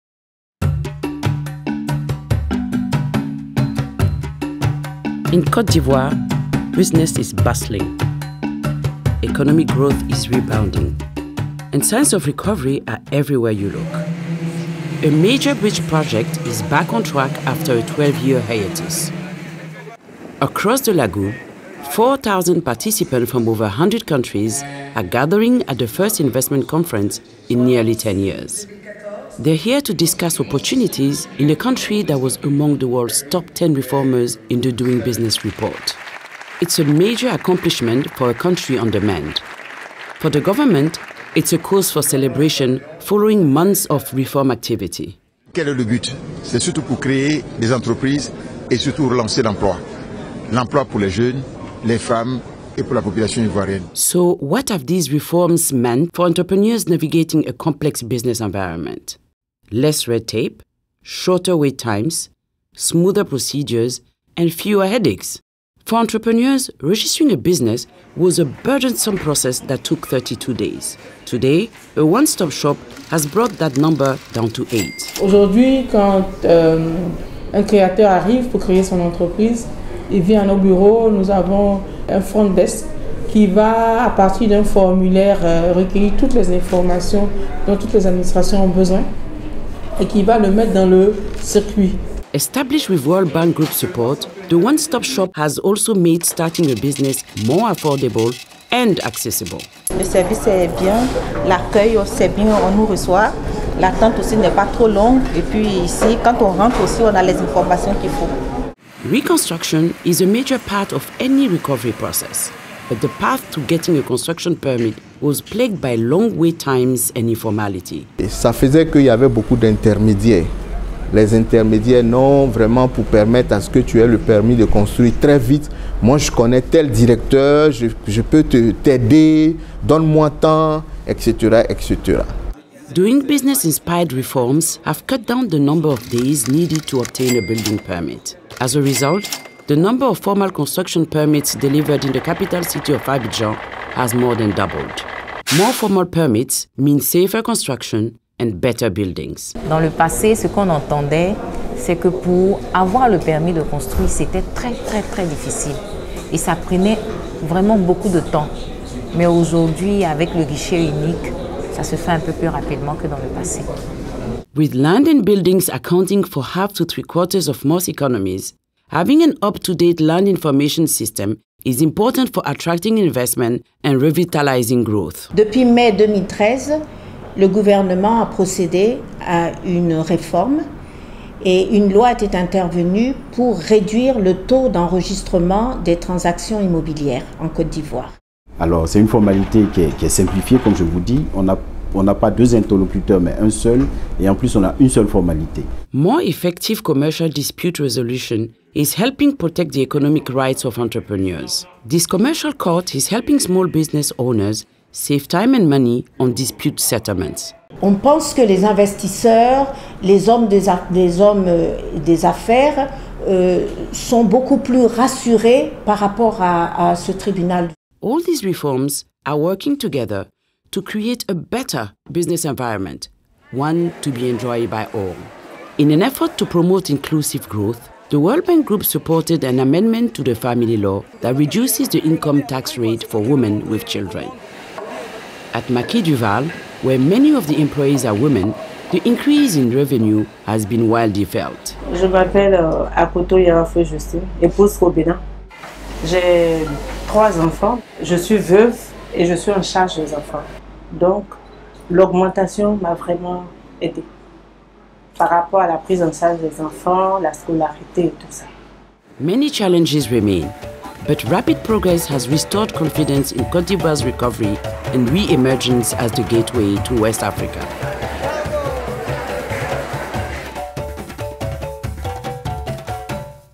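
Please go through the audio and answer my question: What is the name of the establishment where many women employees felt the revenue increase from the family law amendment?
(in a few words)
Maquis Duval.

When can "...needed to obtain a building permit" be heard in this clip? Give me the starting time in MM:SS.
02:16.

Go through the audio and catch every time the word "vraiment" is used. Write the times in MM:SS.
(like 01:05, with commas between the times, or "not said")
02:02, 02:37, 04:12.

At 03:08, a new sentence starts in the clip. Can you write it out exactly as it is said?
Alors, c'est une formalité qui est, simplifiée, comme je vous dis.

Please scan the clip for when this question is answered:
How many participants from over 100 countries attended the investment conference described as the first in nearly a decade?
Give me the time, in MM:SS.
00:21.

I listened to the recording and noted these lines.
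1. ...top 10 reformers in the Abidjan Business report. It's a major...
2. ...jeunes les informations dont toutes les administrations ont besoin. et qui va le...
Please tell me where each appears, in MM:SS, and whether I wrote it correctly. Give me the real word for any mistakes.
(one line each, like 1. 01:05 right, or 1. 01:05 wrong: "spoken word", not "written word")
1. 00:33 wrong: "Doing", not "Abidjan"
2. 01:26 wrong: "toutes", not "jeunes".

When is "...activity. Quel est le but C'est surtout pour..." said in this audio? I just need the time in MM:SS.
00:44.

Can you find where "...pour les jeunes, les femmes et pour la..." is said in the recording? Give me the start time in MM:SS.
00:50.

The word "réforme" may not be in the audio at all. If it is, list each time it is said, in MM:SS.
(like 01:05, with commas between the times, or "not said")
02:59.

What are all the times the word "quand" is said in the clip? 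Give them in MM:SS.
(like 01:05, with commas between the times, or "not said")
01:15, 01:46.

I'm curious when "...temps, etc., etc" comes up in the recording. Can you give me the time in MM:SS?
02:10.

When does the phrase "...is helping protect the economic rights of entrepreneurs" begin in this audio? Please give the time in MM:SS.
03:18.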